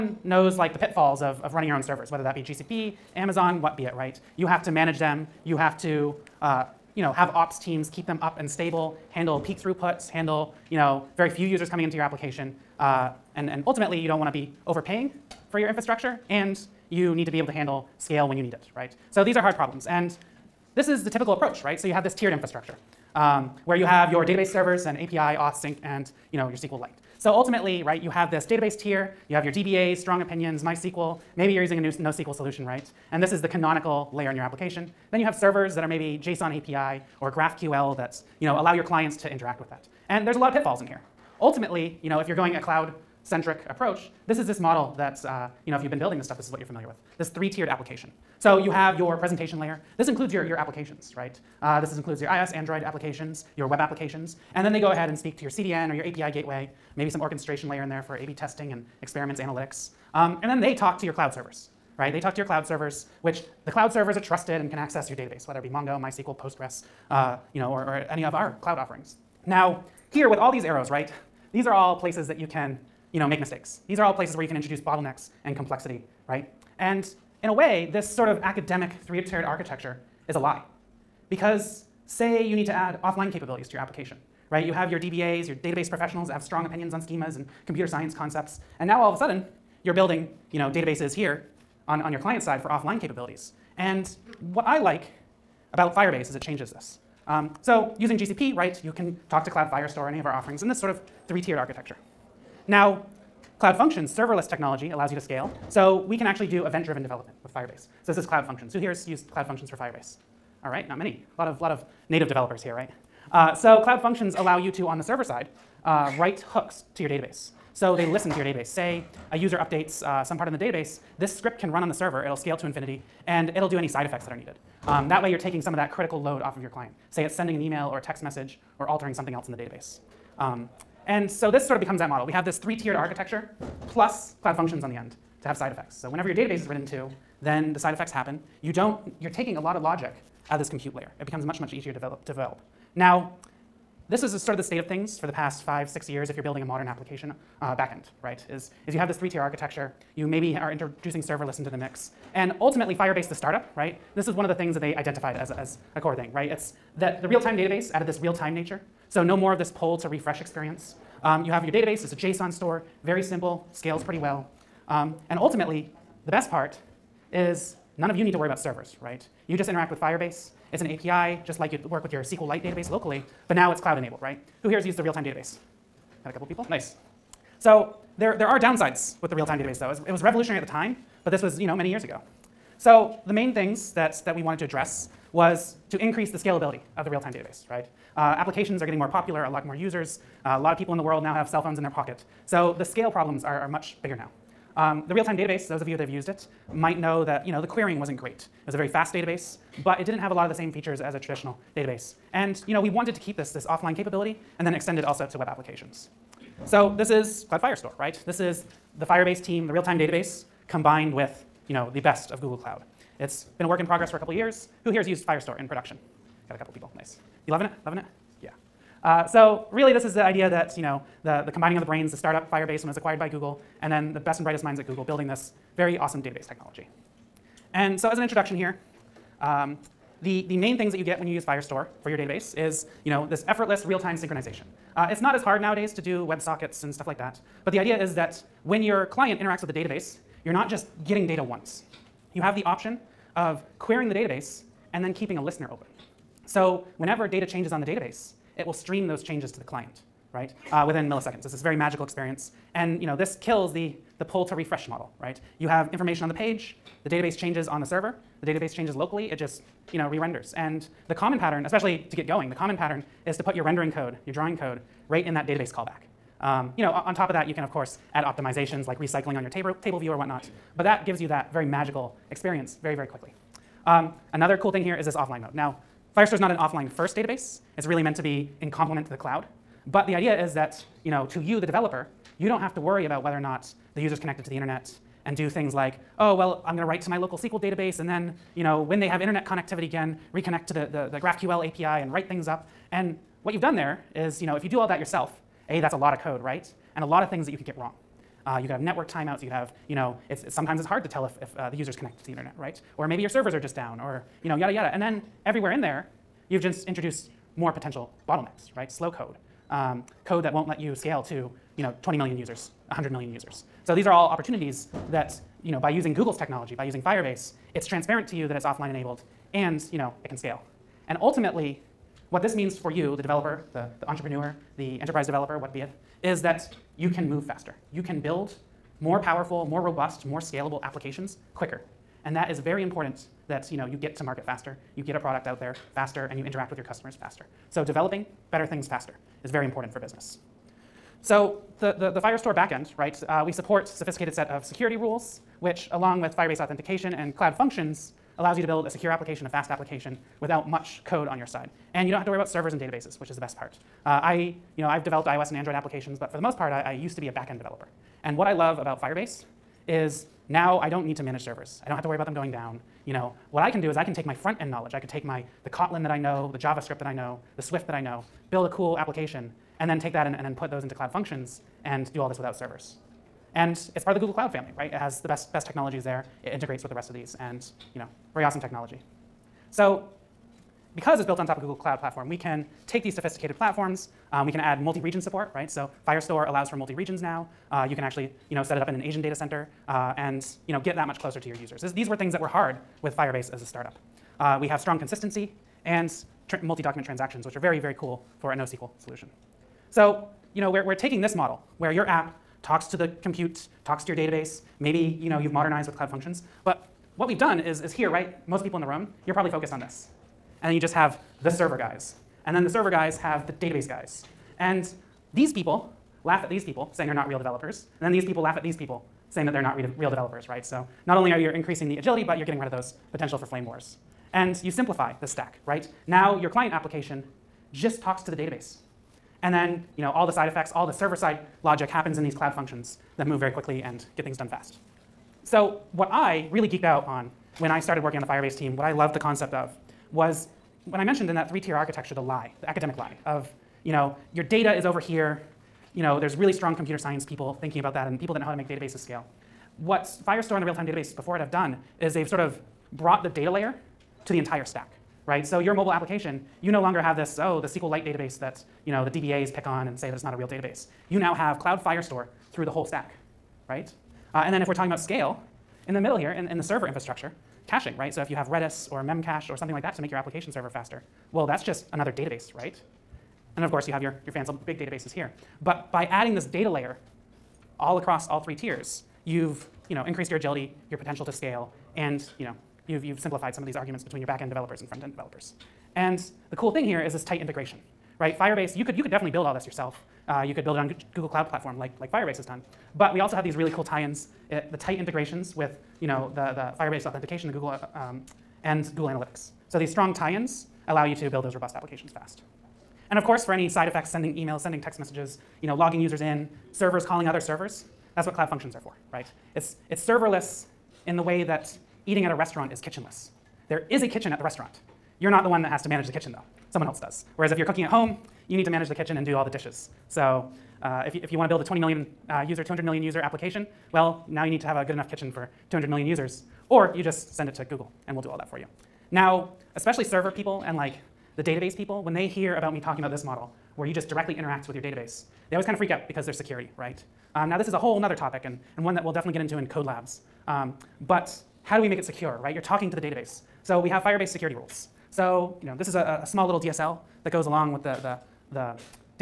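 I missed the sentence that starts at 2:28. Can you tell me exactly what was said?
Is, is you have this three-tier architecture you maybe are introducing serverless into the mix.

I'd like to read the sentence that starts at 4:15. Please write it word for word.
You have information on the page, the database changes on the server, the database changes locally, it just you know, re-renders.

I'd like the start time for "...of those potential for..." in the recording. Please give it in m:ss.
7:02.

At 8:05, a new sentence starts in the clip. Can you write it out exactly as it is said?
And the cool thing here is this tight integration, right?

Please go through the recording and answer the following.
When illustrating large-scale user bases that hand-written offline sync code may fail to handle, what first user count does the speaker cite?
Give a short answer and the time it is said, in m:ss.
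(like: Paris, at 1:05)
20 million, at 5:12.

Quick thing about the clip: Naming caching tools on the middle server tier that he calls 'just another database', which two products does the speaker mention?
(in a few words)
Redis or Memcache.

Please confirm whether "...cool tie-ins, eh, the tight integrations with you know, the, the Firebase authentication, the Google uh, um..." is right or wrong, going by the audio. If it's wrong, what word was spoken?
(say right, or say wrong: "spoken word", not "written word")
right.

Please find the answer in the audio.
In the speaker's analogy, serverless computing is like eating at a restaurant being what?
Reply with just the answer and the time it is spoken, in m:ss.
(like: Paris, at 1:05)
Kitchenless, at 8:32.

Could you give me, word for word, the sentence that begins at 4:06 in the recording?
So whenever data changes on the database, it will stream those changes to the client, right?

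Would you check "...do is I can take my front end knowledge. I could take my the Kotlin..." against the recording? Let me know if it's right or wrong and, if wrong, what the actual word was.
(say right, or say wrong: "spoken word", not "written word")
right.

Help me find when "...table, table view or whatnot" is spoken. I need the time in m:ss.
4:29.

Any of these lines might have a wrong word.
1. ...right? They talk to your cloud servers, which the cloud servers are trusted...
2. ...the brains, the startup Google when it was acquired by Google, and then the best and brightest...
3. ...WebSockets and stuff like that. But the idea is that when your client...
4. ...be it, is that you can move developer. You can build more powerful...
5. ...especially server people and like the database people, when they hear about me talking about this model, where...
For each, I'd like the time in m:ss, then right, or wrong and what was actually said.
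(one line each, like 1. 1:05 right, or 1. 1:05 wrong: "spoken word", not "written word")
1. 1:01 right
2. 3:41 wrong: "Firebase", not "Google"
3. 3:56 right
4. 5:25 wrong: "faster", not "developer"
5. 8:49 right.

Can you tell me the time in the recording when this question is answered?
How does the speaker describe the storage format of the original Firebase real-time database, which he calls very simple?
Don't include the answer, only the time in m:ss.
2:42.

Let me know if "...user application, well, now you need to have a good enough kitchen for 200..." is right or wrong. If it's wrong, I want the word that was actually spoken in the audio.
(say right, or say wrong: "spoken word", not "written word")
right.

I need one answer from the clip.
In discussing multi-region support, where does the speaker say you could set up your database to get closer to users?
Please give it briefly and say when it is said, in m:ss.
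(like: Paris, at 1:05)
An Asian data center, at 6:28.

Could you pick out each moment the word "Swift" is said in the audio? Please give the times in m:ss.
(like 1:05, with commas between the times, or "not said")
6:07.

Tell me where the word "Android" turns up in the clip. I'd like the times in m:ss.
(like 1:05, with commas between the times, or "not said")
0:52, 5:55.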